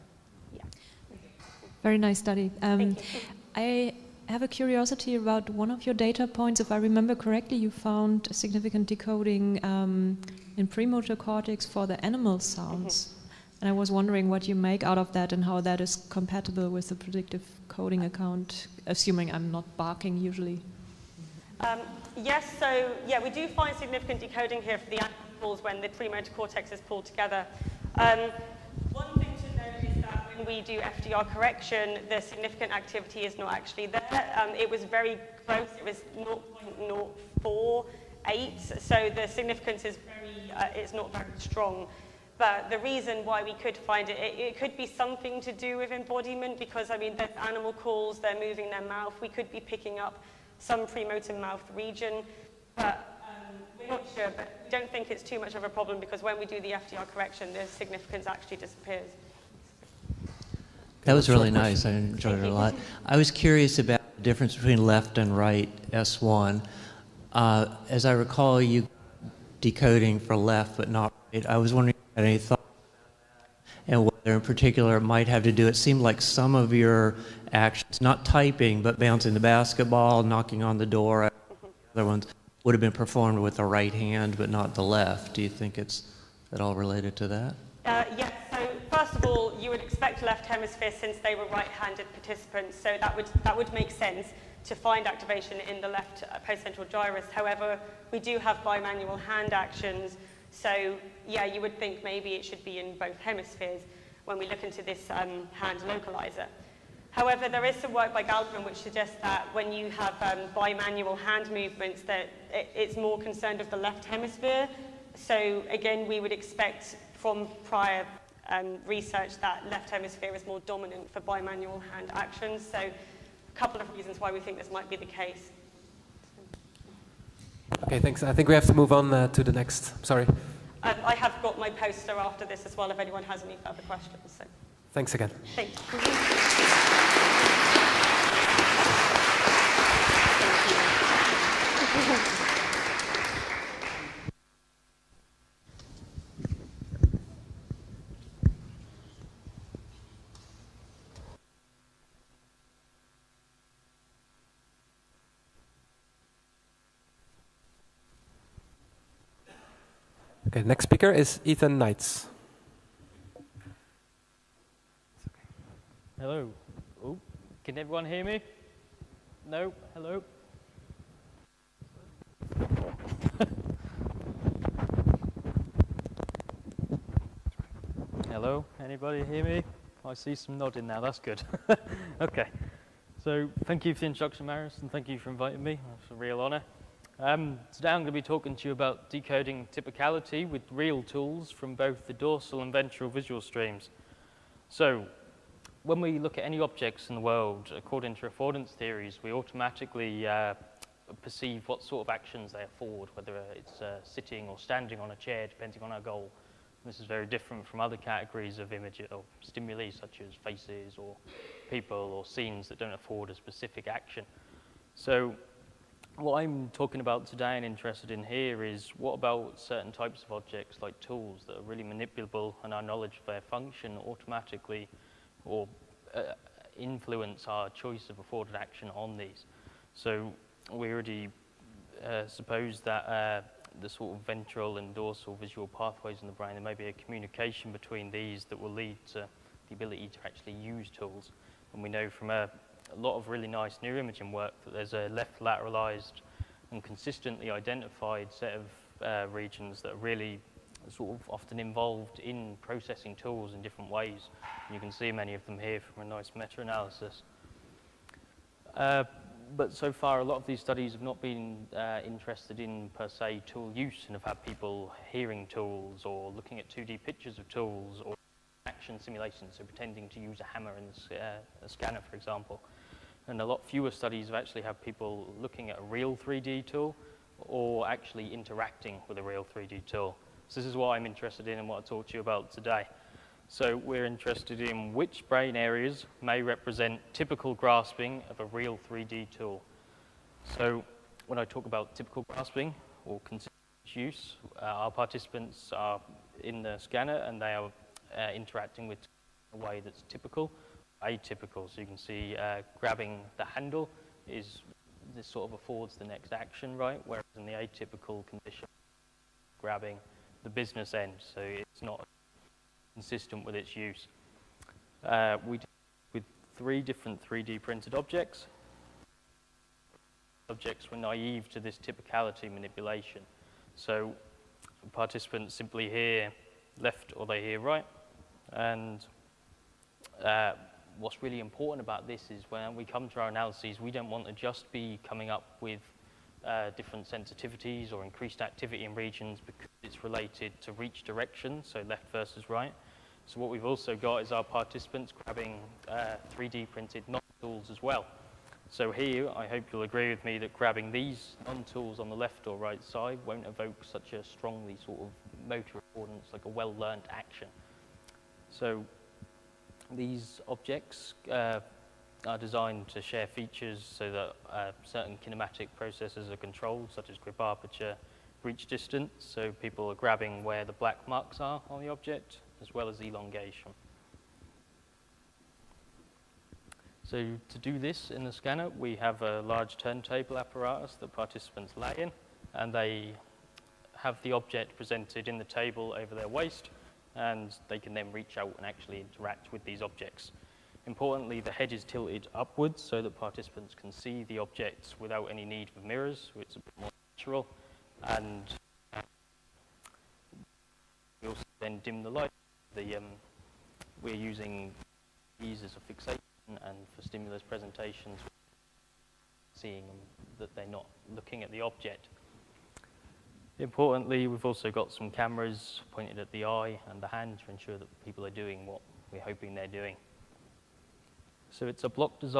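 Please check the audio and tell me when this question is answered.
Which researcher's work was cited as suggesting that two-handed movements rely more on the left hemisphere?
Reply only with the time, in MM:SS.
01:48.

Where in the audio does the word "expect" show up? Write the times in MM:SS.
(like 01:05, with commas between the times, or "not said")
01:29, 01:56.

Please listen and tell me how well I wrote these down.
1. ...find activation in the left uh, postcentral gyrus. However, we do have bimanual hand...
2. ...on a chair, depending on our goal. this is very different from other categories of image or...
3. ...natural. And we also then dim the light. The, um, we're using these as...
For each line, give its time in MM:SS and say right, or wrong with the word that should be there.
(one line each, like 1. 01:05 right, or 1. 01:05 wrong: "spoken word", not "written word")
1. 01:34 right
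2. 03:24 right
3. 06:37 right.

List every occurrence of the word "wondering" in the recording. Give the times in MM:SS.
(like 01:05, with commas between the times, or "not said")
00:13, 01:11.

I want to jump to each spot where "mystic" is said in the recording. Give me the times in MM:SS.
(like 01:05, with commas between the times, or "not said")
not said.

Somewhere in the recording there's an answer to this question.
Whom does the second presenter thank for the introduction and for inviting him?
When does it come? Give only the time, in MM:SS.
03:04.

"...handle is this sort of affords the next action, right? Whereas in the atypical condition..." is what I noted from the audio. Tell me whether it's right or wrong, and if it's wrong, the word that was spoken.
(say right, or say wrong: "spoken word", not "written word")
right.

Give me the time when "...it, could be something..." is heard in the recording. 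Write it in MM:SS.
00:44.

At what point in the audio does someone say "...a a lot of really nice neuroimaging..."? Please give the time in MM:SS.
04:02.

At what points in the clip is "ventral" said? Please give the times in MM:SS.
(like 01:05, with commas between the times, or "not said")
03:12, 03:54.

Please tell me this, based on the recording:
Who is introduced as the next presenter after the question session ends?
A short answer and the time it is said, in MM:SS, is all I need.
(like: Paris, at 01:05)
Ethan Knights, at 02:41.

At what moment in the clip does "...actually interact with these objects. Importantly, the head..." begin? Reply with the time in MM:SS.
06:28.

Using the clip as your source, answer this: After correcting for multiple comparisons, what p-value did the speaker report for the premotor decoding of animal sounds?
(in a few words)
0.048.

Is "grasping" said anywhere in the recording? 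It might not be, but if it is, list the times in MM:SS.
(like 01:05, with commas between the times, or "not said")
04:47, 04:52.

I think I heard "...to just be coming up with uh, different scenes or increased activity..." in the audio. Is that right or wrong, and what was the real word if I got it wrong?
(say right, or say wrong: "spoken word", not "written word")
wrong: "sensitivities", not "scenes".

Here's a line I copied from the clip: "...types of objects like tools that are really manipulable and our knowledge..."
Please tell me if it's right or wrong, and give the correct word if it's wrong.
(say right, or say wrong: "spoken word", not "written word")
right.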